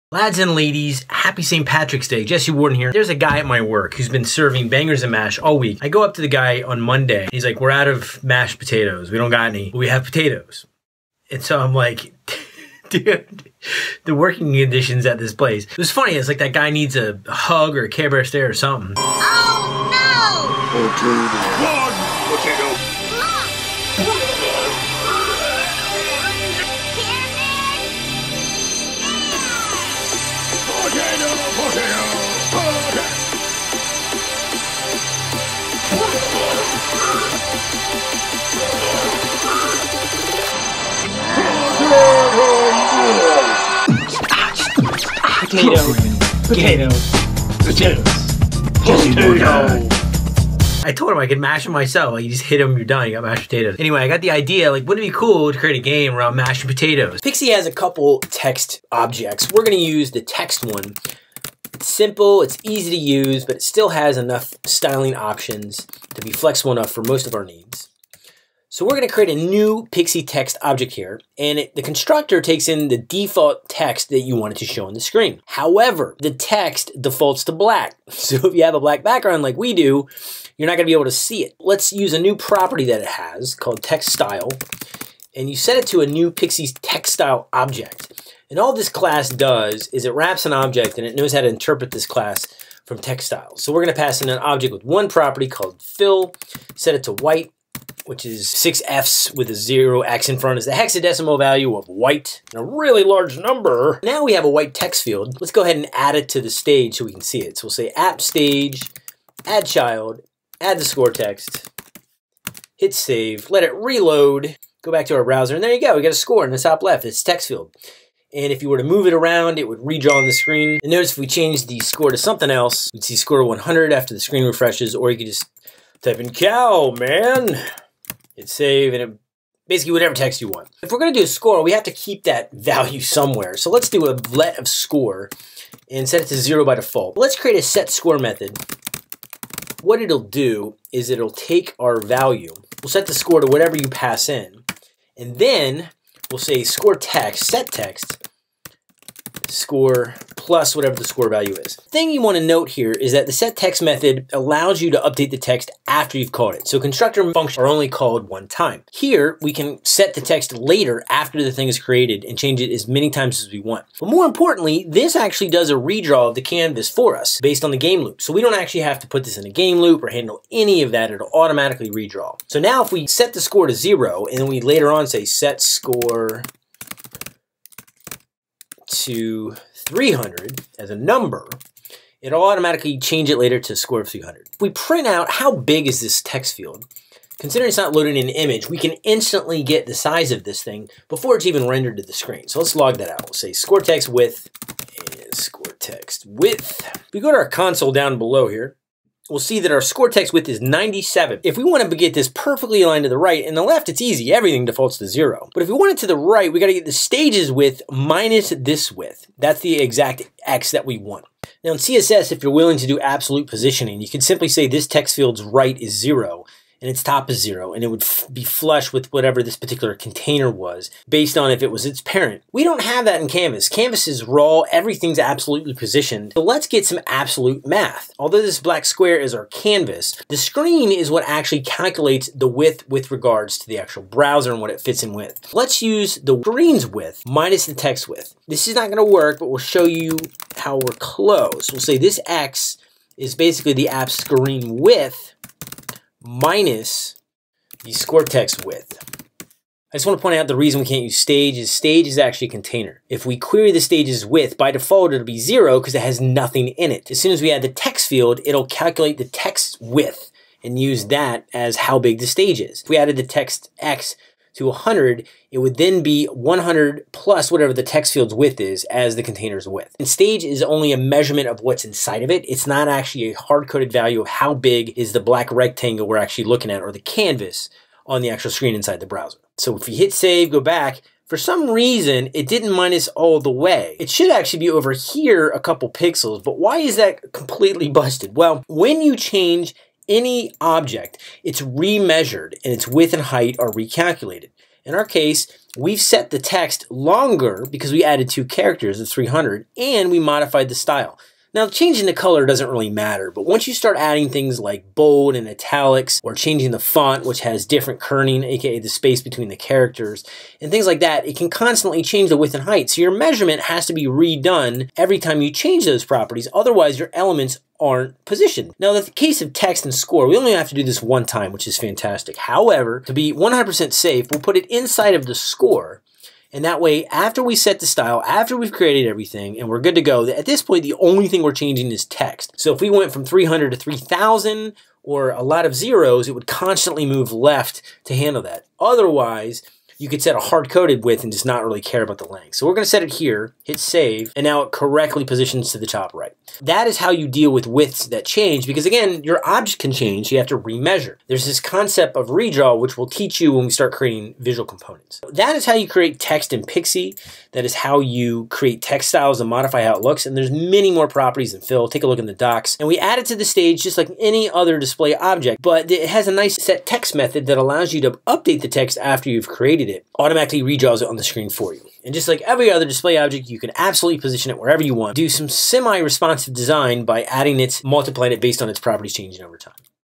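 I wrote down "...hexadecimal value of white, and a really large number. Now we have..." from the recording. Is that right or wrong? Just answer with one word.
right.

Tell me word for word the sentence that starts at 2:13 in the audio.
So let's do a let of score and set it to zero by default.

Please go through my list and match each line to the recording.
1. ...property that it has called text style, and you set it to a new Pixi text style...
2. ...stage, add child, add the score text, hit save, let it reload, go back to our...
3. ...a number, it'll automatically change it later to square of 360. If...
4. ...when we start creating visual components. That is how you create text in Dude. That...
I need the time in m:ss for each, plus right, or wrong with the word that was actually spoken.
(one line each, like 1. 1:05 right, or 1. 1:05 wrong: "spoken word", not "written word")
1. 1:22 right
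2. 1:48 right
3. 3:00 wrong: "300", not "360"
4. 5:53 wrong: "Pixi", not "Dude".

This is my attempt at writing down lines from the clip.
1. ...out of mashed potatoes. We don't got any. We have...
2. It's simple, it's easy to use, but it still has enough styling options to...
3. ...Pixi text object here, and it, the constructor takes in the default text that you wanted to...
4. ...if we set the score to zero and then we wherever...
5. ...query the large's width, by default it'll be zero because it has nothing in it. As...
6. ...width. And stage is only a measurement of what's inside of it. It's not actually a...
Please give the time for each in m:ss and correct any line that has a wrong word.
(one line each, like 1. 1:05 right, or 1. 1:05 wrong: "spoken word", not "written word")
1. 0:07 right
2. 1:01 right
3. 1:09 right
4. 2:52 wrong: "later", not "wherever"
5. 4:13 wrong: "stage", not "large"
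6. 4:29 right.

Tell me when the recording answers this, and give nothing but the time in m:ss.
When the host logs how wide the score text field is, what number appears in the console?
3:20.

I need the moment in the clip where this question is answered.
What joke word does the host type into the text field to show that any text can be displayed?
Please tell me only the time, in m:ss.
2:06.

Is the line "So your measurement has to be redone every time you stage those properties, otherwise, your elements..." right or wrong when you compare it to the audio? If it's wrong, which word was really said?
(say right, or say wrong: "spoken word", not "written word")
wrong: "change", not "stage".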